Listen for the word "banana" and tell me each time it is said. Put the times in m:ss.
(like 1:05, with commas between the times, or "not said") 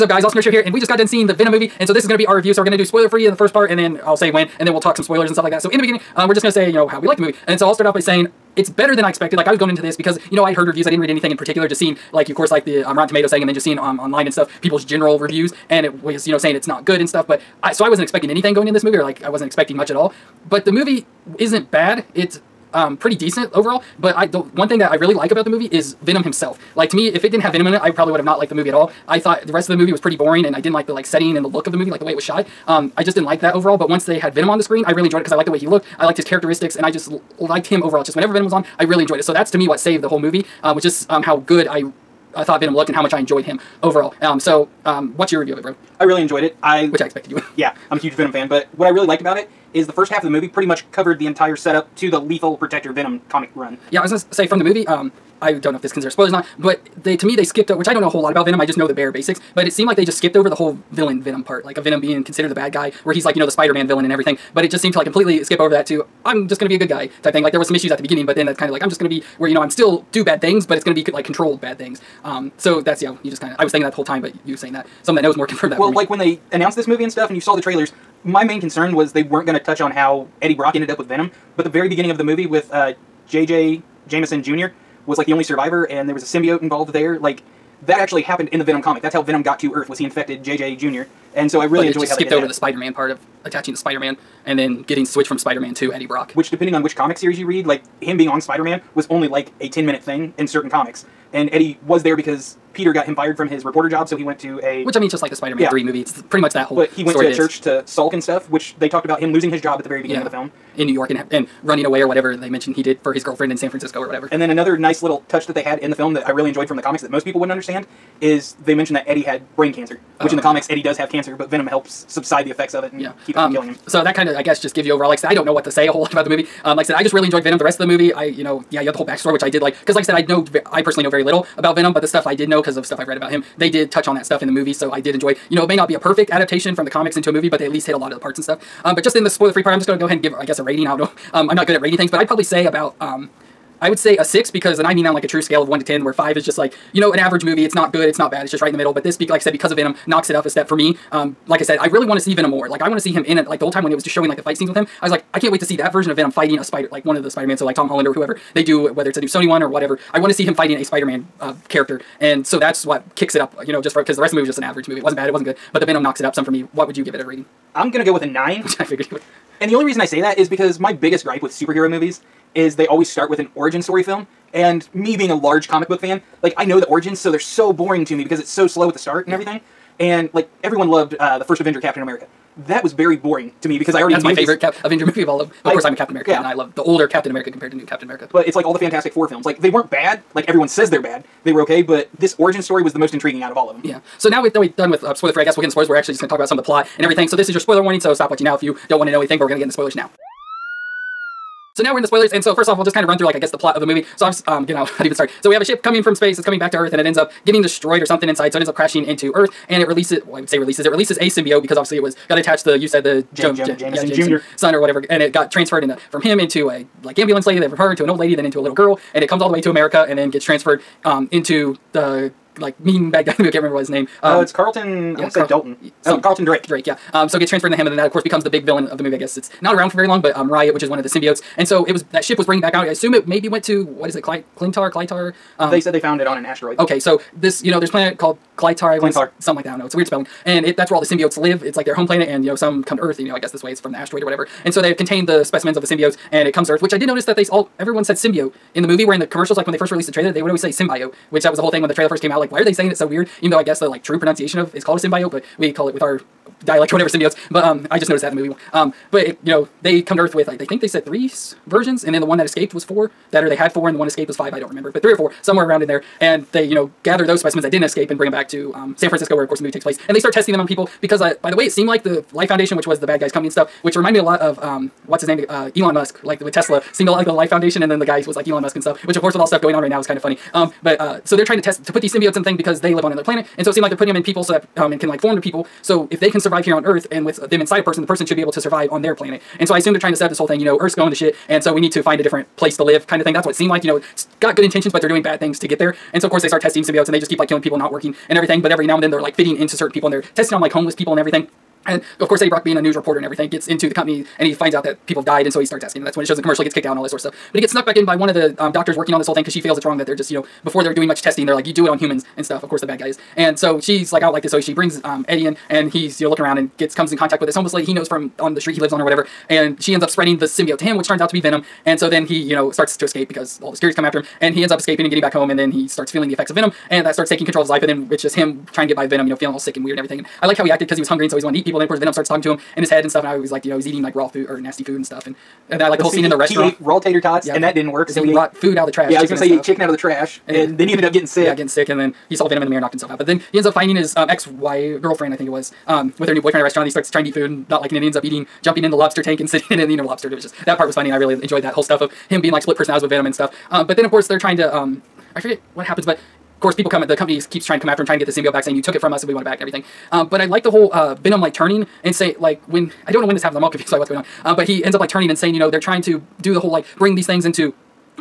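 not said.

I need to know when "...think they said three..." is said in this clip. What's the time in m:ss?
4:20.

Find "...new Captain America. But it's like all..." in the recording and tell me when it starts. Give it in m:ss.
3:07.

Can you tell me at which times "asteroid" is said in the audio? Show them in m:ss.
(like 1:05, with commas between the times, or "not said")
3:56, 4:03.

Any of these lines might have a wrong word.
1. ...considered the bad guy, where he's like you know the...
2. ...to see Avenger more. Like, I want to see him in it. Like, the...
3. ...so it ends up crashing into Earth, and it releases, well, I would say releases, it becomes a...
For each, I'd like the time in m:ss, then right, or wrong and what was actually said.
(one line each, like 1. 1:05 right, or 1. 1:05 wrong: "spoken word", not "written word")
1. 1:02 right
2. 2:32 wrong: "Venom", not "Avenger"
3. 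3:28 wrong: "releases", not "becomes".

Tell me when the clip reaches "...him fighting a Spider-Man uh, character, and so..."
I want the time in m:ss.
2:40.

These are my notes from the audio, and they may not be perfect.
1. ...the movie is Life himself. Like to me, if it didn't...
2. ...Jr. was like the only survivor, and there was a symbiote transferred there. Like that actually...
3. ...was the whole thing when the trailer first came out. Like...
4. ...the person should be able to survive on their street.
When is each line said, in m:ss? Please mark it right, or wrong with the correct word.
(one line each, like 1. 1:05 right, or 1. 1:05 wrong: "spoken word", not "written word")
1. 0:25 wrong: "Venom", not "Life"
2. 1:24 wrong: "involved", not "transferred"
3. 4:11 right
4. 4:48 wrong: "planet", not "street".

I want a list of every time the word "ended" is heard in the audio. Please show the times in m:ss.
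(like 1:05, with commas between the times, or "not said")
1:20, 5:40.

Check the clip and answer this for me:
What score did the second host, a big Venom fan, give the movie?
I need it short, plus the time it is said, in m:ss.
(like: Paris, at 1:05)
9, at 2:47.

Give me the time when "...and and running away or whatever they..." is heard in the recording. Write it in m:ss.
1:51.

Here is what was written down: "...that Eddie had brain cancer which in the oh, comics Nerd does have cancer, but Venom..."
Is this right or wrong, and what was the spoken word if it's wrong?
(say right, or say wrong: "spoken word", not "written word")
wrong: "Eddie", not "Nerd".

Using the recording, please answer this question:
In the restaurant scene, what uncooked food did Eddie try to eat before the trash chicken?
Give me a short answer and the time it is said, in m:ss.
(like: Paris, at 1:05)
Raw tater tots, at 5:36.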